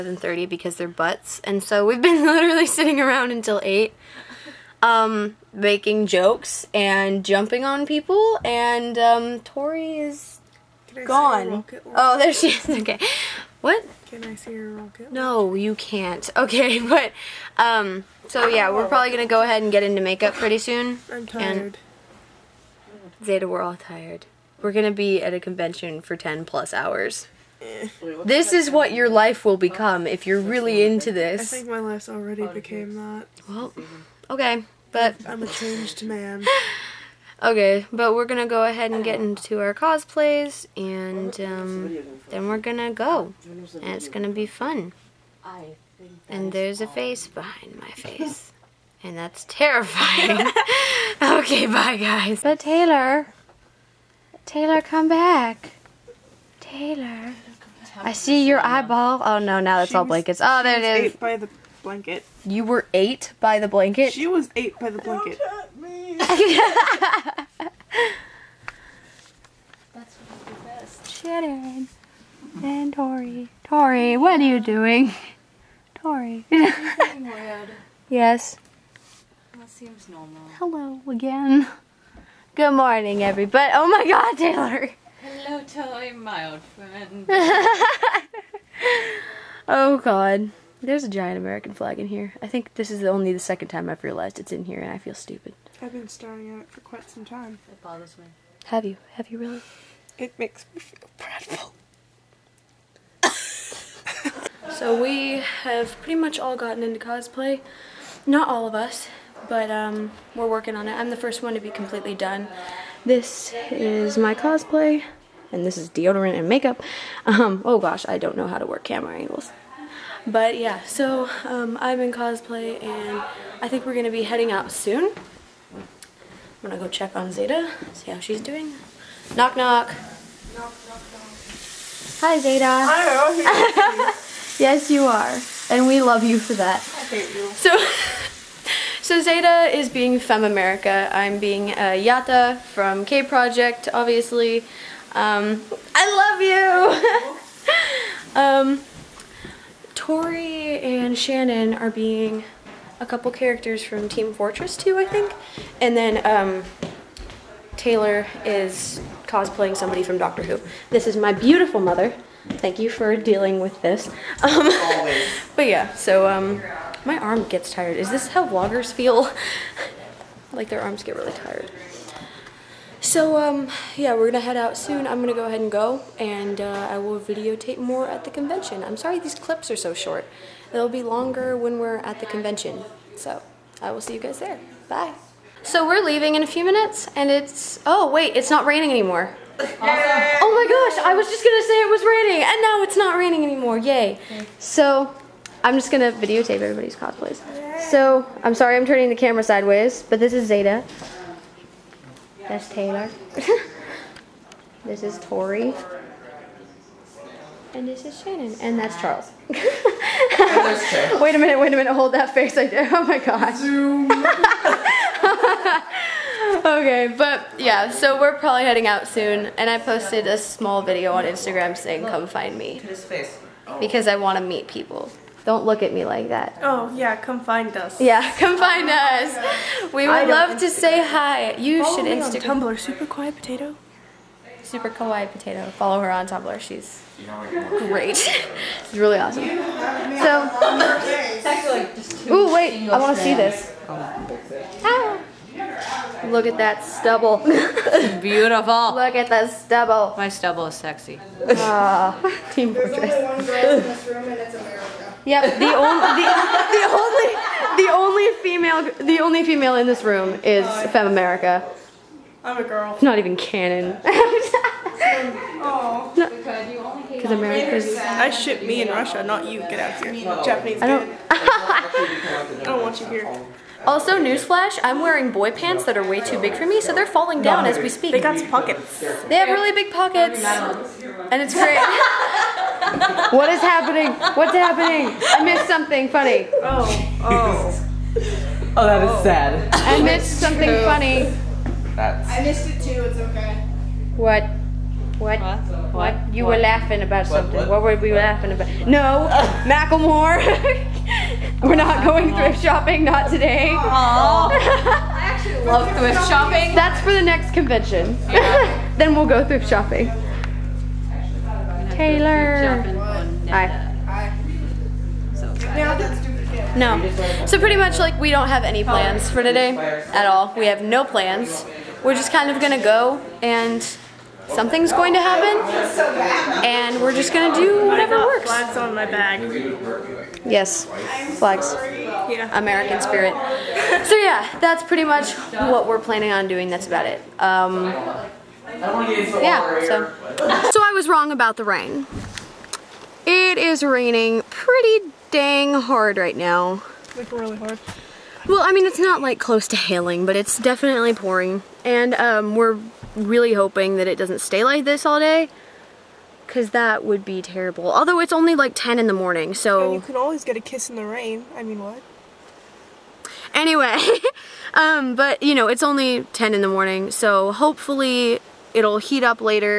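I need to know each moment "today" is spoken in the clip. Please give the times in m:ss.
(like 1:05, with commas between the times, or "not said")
5:03, 5:19.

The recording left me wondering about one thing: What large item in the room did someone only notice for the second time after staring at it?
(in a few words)
American flag.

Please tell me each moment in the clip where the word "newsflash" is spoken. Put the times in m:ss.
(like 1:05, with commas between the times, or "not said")
4:34.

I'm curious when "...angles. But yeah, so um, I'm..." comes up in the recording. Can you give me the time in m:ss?
1:59.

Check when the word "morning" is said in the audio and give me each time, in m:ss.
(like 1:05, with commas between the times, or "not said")
1:22, 5:59, 6:06.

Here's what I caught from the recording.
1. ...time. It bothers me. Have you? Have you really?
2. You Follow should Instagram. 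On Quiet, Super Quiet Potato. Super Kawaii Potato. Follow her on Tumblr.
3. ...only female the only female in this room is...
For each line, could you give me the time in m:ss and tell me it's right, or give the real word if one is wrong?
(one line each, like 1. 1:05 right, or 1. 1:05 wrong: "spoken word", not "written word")
1. 1:37 right
2. 3:51 wrong: "Tumblr", not "Quiet"
3. 4:17 right.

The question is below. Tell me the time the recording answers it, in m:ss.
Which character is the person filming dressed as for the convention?
2:22.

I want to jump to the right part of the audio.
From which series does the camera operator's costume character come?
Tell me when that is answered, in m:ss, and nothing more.
2:23.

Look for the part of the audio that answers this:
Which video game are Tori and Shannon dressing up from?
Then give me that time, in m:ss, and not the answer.
2:34.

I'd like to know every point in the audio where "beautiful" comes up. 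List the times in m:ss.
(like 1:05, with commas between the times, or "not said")
2:41, 4:08.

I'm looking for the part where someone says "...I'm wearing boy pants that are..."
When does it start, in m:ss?
4:34.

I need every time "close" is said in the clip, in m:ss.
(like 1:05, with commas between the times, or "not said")
5:49.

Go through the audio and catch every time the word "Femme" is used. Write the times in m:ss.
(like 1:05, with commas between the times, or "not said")
2:20, 4:20.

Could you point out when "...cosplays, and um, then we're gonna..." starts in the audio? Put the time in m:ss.
0:39.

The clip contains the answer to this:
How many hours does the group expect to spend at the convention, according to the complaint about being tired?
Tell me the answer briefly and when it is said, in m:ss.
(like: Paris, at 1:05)
10 plus, at 0:26.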